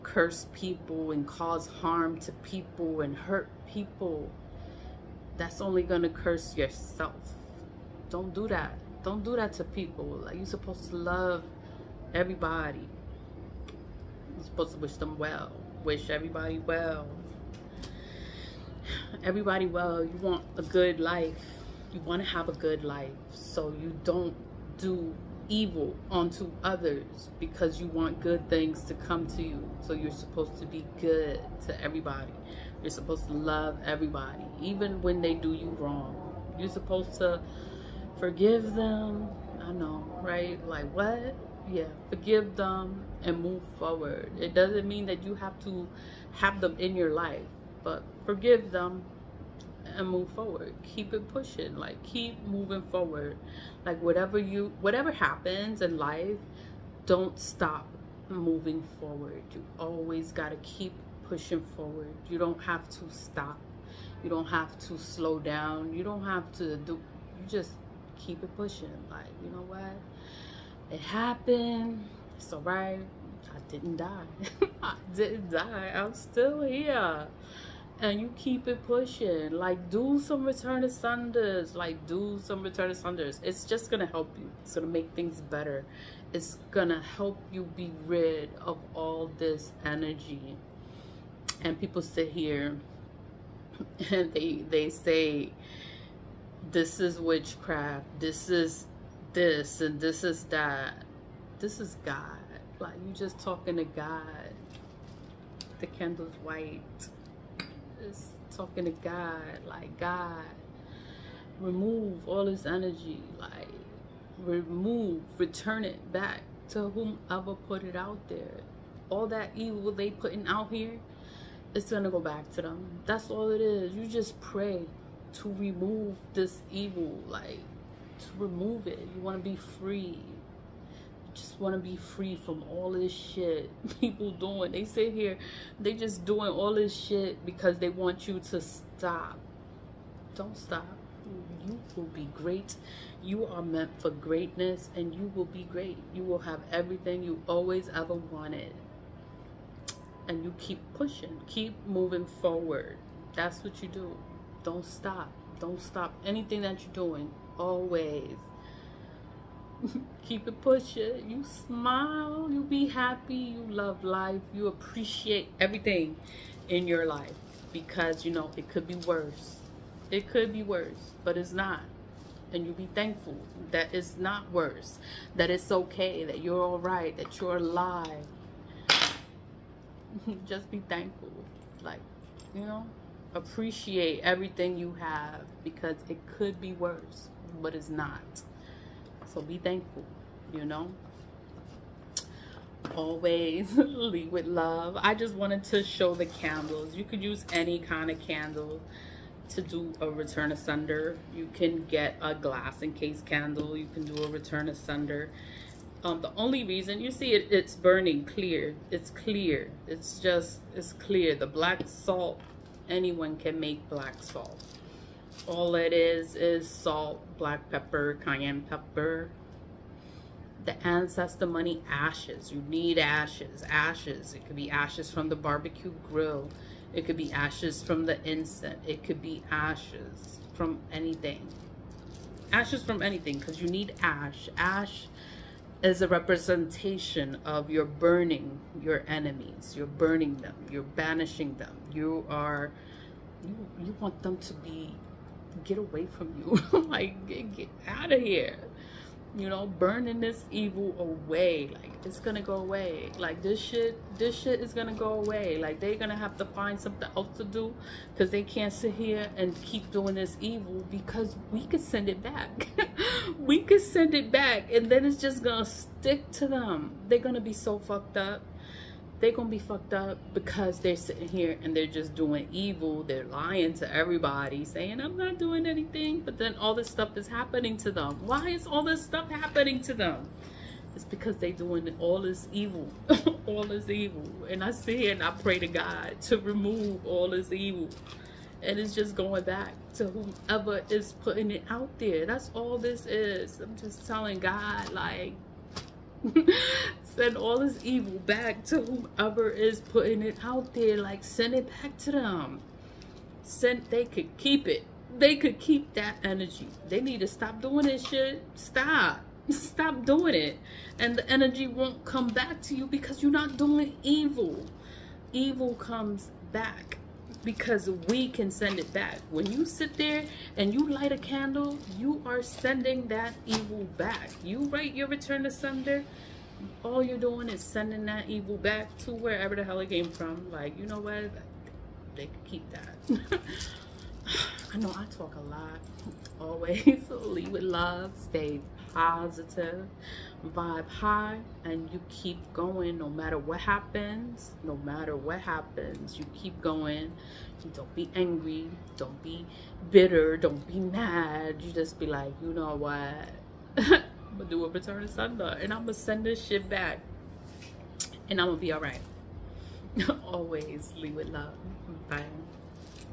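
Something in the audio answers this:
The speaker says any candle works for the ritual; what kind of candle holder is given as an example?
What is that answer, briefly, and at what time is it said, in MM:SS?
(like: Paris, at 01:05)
Glass encased, at 03:22.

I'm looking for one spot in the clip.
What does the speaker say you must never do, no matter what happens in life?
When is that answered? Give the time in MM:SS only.
00:57.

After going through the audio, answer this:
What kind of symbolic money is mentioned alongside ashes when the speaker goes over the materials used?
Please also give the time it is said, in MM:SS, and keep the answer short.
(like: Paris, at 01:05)
Ancestor money, at 03:40.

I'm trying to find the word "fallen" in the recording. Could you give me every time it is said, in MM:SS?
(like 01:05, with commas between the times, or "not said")
not said.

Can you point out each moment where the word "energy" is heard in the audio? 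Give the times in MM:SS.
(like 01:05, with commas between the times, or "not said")
01:29, 01:52, 05:06, 05:11.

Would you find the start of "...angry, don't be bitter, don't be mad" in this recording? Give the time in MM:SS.
05:48.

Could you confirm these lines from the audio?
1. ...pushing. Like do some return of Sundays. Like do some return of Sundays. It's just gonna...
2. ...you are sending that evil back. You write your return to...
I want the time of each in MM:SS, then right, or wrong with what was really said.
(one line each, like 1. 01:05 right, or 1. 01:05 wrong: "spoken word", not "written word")
1. 01:18 right
2. 05:21 right.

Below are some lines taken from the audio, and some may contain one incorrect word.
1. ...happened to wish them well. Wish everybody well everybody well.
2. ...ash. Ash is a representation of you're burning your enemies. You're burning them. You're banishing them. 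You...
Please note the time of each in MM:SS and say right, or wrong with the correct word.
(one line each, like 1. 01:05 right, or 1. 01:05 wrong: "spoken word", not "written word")
1. 00:14 wrong: "supposed", not "happened"
2. 03:54 right.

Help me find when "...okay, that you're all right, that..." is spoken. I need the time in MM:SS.
02:55.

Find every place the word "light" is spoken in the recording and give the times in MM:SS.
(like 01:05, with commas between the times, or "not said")
05:20.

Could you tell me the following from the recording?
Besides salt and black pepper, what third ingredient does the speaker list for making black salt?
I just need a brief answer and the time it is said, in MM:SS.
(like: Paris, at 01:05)
Cayenne pepper, at 03:38.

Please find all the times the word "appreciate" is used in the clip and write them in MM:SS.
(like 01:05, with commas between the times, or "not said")
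02:44, 03:03.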